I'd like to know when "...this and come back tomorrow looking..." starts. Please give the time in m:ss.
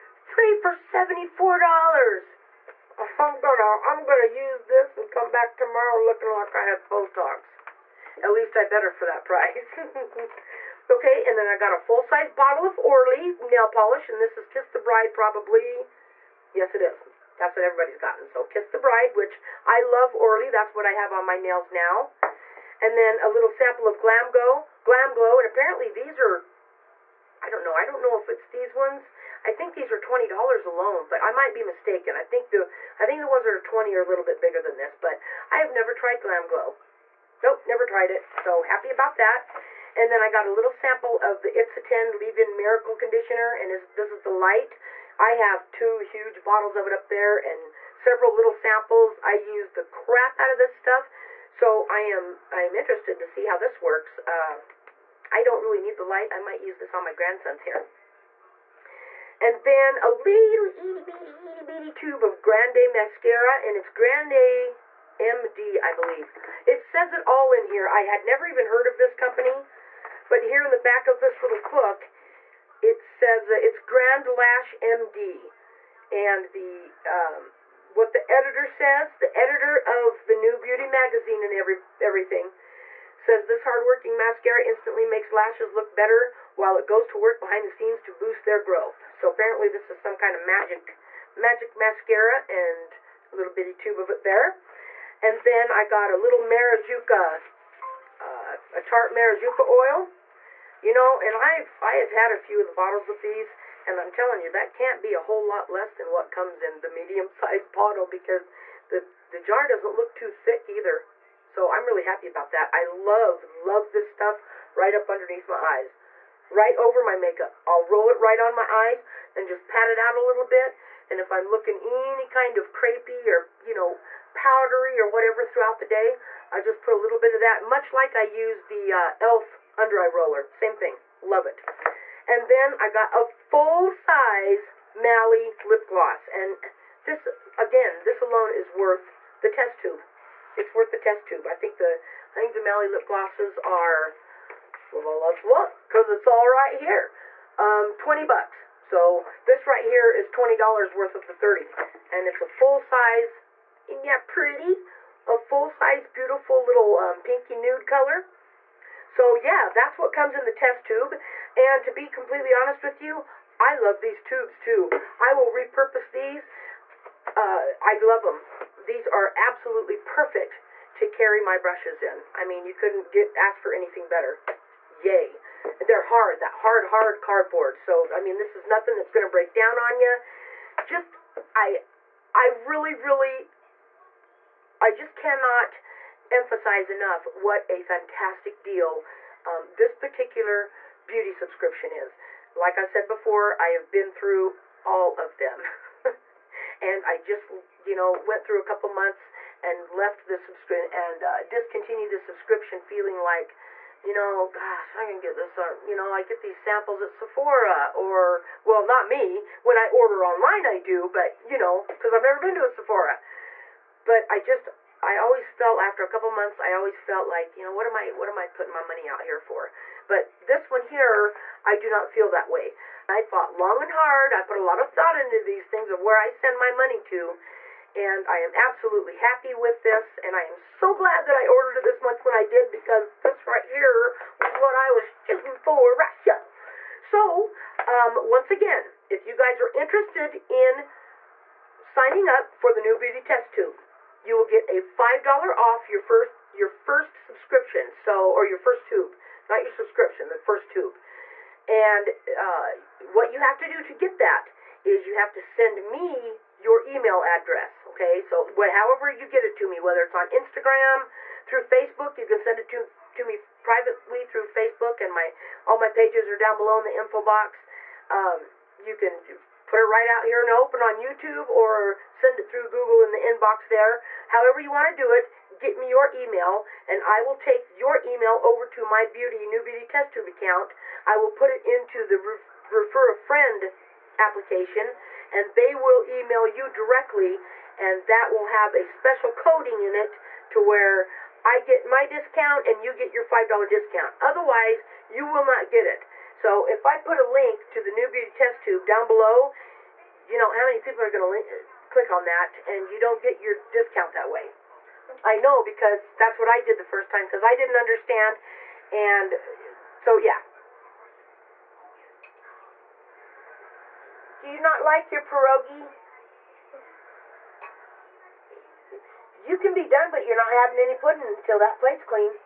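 0:04.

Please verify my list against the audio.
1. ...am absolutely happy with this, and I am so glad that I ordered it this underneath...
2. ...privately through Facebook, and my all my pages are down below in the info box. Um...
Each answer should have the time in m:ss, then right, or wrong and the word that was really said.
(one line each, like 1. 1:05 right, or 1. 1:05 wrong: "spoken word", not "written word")
1. 3:48 wrong: "month", not "underneath"
2. 4:23 right.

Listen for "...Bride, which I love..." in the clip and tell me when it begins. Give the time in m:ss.
0:18.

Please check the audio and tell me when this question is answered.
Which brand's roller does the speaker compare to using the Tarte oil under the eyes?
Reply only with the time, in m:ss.
2:09.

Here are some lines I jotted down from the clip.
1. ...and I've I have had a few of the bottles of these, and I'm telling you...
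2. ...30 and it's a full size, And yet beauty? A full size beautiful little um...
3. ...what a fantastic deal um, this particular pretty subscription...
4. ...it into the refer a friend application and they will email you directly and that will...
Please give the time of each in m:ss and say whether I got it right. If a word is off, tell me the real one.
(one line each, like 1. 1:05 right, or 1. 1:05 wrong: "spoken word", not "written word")
1. 1:41 right
2. 2:31 wrong: "pretty", not "beauty"
3. 3:07 wrong: "beauty", not "pretty"
4. 4:41 right.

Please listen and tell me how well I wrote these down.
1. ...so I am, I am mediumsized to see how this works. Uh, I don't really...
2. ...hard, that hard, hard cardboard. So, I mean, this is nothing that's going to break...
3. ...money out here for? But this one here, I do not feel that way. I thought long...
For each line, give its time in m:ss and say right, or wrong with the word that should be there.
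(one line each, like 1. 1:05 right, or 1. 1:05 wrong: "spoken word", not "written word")
1. 0:51 wrong: "interested", not "mediumsized"
2. 2:56 right
3. 3:38 right.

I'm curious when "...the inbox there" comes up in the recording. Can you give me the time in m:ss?
4:33.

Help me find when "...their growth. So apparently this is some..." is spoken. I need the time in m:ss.
1:28.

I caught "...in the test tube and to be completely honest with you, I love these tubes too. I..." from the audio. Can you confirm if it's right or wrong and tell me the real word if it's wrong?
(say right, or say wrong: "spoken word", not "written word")
right.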